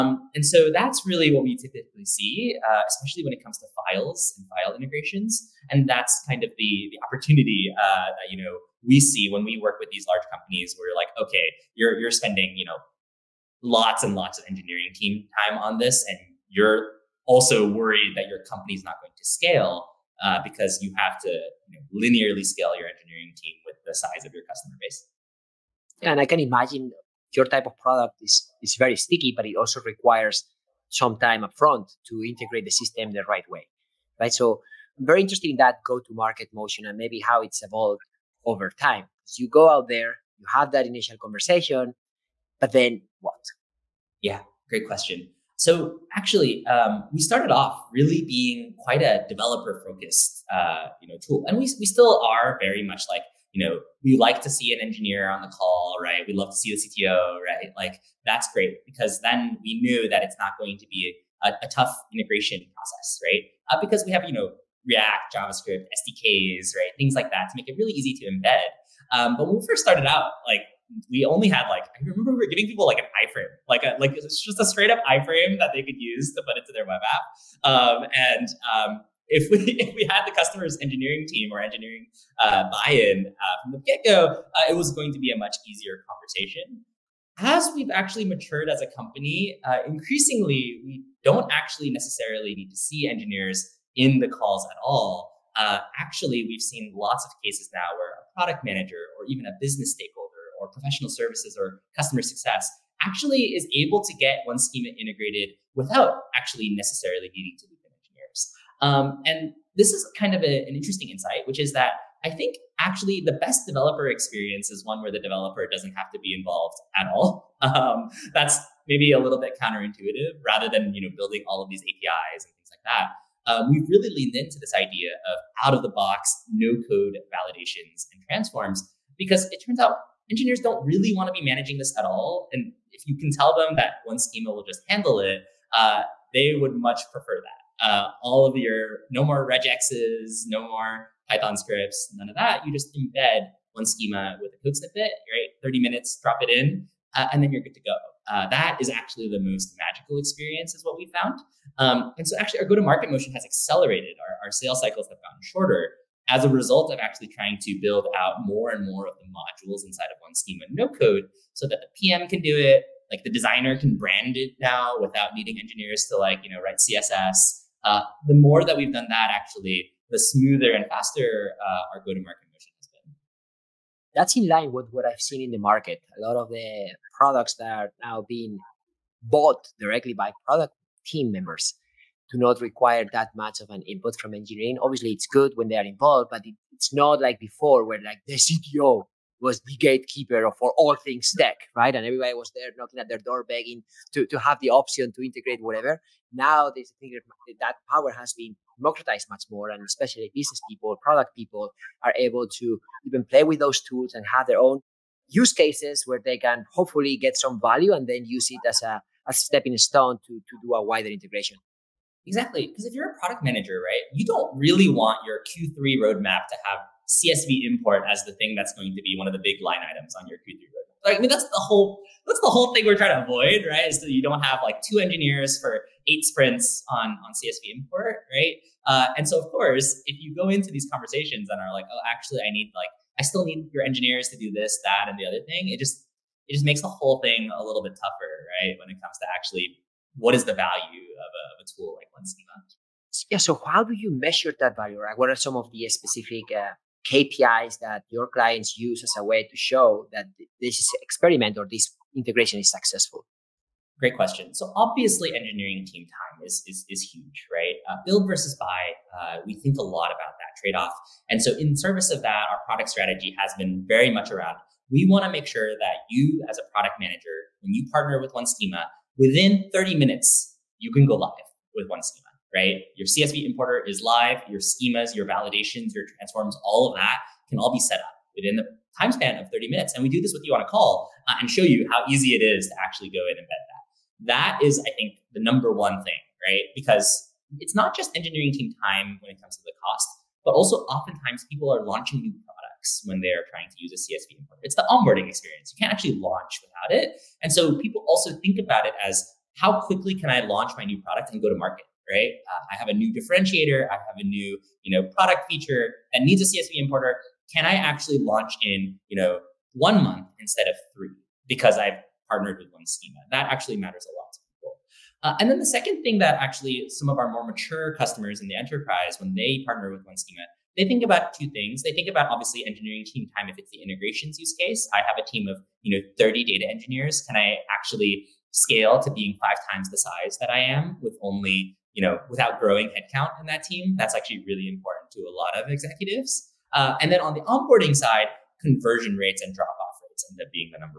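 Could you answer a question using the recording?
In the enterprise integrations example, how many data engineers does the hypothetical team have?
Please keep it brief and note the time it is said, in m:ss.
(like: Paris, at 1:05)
30, at 5:26.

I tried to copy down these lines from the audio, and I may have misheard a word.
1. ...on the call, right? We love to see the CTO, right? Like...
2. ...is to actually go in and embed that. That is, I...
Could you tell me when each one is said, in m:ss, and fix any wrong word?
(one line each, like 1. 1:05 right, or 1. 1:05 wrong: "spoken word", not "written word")
1. 0:55 right
2. 4:42 right.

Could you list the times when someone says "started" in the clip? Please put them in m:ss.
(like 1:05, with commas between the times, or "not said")
0:47, 1:09.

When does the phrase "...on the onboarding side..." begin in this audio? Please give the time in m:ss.
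5:37.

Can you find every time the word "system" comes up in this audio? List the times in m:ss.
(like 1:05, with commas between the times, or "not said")
0:32.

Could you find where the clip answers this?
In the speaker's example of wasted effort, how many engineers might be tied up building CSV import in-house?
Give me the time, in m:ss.
3:44.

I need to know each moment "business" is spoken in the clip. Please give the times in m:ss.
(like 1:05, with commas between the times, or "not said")
1:39, 3:20.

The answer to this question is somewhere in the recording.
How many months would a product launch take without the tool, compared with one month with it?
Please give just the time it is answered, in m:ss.
5:10.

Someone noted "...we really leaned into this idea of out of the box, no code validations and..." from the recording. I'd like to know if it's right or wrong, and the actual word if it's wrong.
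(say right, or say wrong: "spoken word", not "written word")
right.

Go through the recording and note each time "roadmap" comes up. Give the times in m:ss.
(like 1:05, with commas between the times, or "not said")
3:36, 3:40.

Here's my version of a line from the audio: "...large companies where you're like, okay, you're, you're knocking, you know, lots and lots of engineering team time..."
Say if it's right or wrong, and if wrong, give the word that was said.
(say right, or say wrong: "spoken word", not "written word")
wrong: "spending", not "knocking".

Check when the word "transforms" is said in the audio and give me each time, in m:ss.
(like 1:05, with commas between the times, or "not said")
2:08, 4:36.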